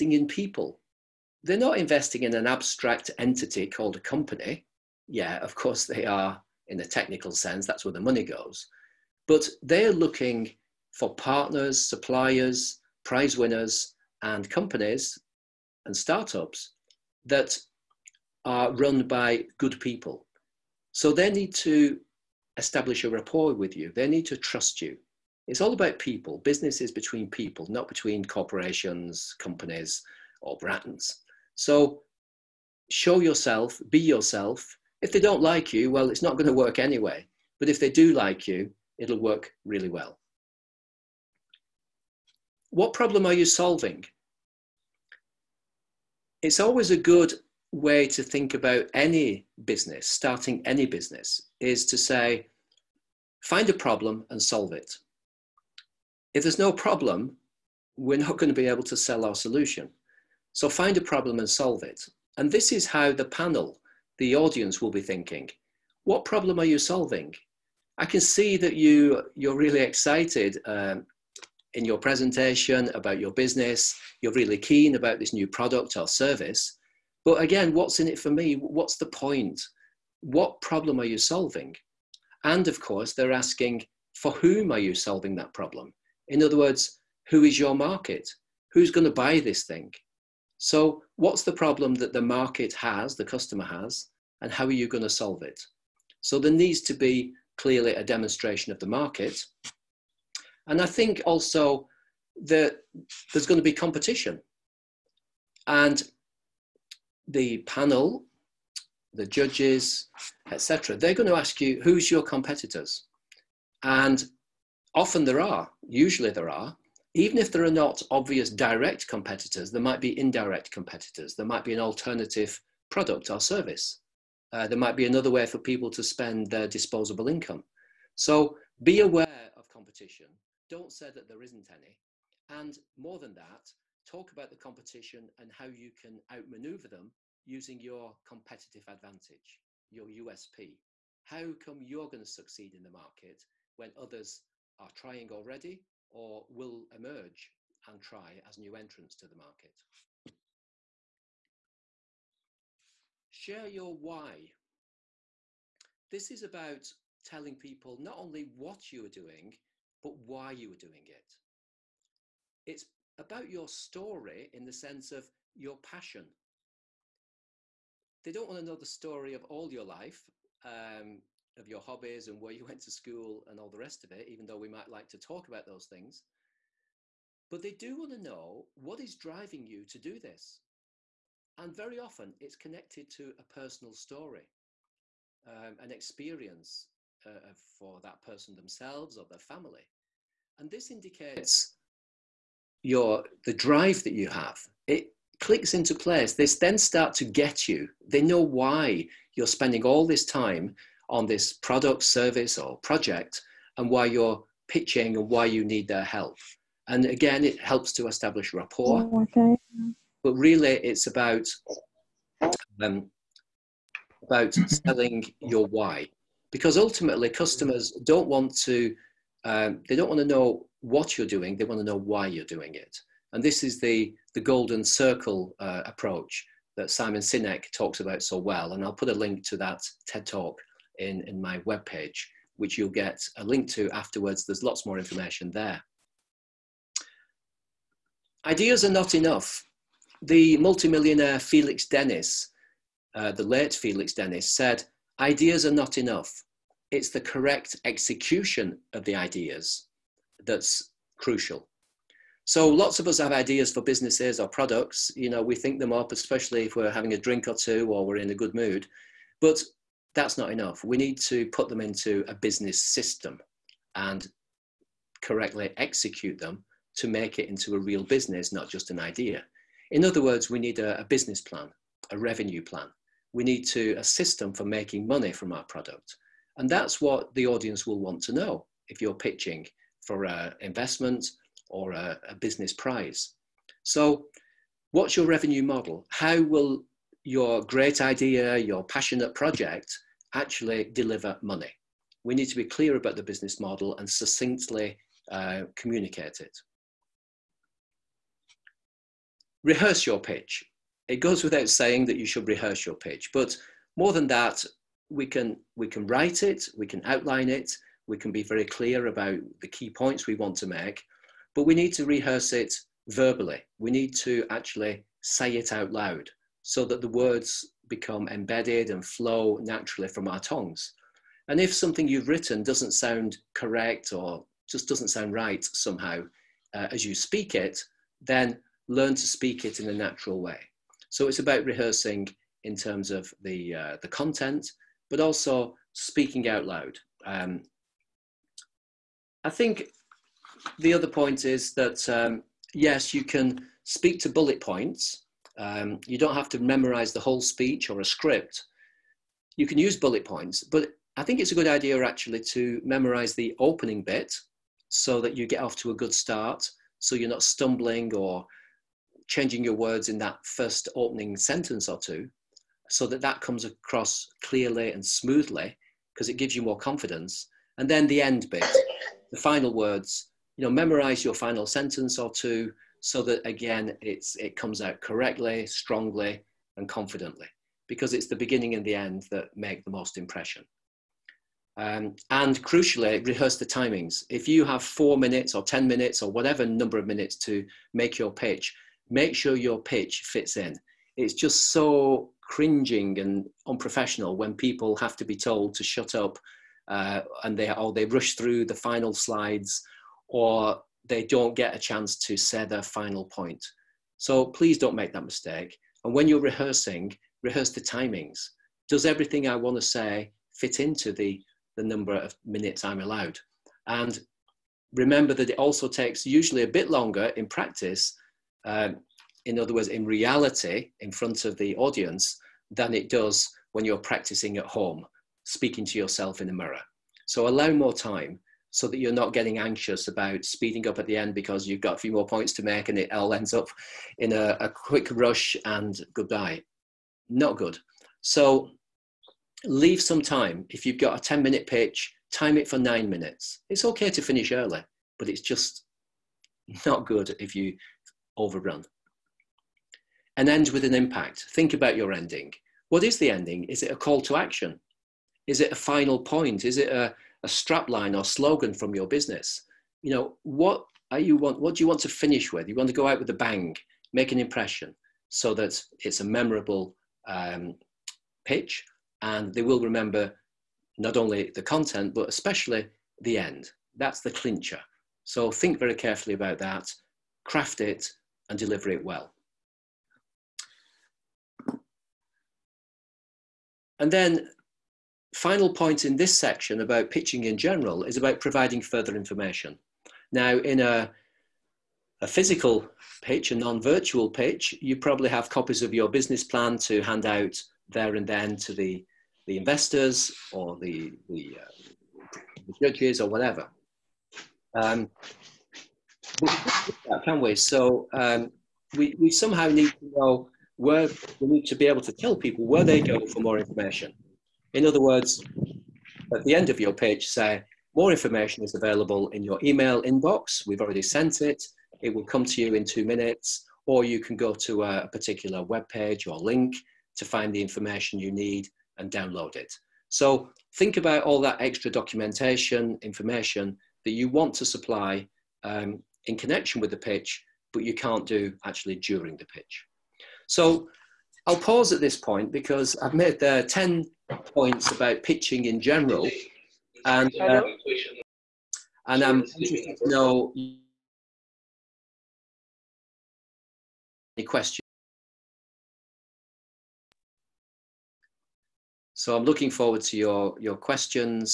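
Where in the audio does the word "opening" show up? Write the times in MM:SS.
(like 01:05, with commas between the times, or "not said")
05:53, 06:00.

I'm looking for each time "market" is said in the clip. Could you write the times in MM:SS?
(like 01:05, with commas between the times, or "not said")
01:27, 01:32, 01:38, 02:22, 02:29.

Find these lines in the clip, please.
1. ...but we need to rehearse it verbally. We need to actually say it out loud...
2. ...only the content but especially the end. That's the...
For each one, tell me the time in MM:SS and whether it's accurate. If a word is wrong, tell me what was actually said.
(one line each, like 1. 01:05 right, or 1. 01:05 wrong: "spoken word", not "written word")
1. 05:11 right
2. 07:51 right.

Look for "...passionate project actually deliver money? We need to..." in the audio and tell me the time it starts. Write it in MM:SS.
04:48.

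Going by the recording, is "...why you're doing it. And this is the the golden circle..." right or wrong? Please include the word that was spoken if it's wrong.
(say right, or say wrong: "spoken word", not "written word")
right.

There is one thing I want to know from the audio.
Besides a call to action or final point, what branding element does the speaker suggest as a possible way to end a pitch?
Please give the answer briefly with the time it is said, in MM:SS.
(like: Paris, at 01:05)
Strapline or slogan, at 07:37.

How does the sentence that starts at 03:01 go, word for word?
And very often it's connected to a personal story, um, an experience uh, for that person themselves or their family.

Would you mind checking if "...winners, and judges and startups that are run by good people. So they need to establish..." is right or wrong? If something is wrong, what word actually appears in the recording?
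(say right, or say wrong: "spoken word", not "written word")
wrong: "companies", not "judges".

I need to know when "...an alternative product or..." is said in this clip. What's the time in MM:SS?
02:01.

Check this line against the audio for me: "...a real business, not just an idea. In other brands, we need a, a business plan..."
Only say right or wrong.
wrong.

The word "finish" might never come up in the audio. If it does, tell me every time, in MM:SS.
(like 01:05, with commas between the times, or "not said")
07:24, 07:42.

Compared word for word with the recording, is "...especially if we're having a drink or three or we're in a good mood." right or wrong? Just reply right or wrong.
wrong.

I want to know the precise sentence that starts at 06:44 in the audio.
So please don't make that mistake.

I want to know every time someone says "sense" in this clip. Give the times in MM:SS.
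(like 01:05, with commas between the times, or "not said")
00:07, 02:44.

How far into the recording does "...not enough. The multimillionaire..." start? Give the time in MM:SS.
03:58.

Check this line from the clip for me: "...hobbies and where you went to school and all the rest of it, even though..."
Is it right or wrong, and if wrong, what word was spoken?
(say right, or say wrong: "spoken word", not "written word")
right.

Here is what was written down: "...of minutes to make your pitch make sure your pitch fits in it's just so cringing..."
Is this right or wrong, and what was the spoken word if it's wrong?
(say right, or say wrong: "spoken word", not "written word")
right.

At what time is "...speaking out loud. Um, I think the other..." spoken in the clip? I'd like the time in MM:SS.
05:35.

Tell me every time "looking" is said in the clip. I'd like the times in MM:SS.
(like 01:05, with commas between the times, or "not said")
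00:09, 09:19.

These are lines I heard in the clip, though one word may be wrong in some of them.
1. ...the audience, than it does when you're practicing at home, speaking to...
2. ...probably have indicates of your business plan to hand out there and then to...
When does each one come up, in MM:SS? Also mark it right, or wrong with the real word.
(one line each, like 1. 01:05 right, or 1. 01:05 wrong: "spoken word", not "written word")
1. 07:01 right
2. 08:14 wrong: "copies", not "indicates".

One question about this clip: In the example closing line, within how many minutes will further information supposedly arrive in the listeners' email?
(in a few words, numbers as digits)
2.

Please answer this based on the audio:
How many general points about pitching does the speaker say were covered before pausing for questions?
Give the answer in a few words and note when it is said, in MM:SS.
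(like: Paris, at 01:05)
10, at 09:03.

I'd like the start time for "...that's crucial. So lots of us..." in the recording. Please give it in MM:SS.
04:10.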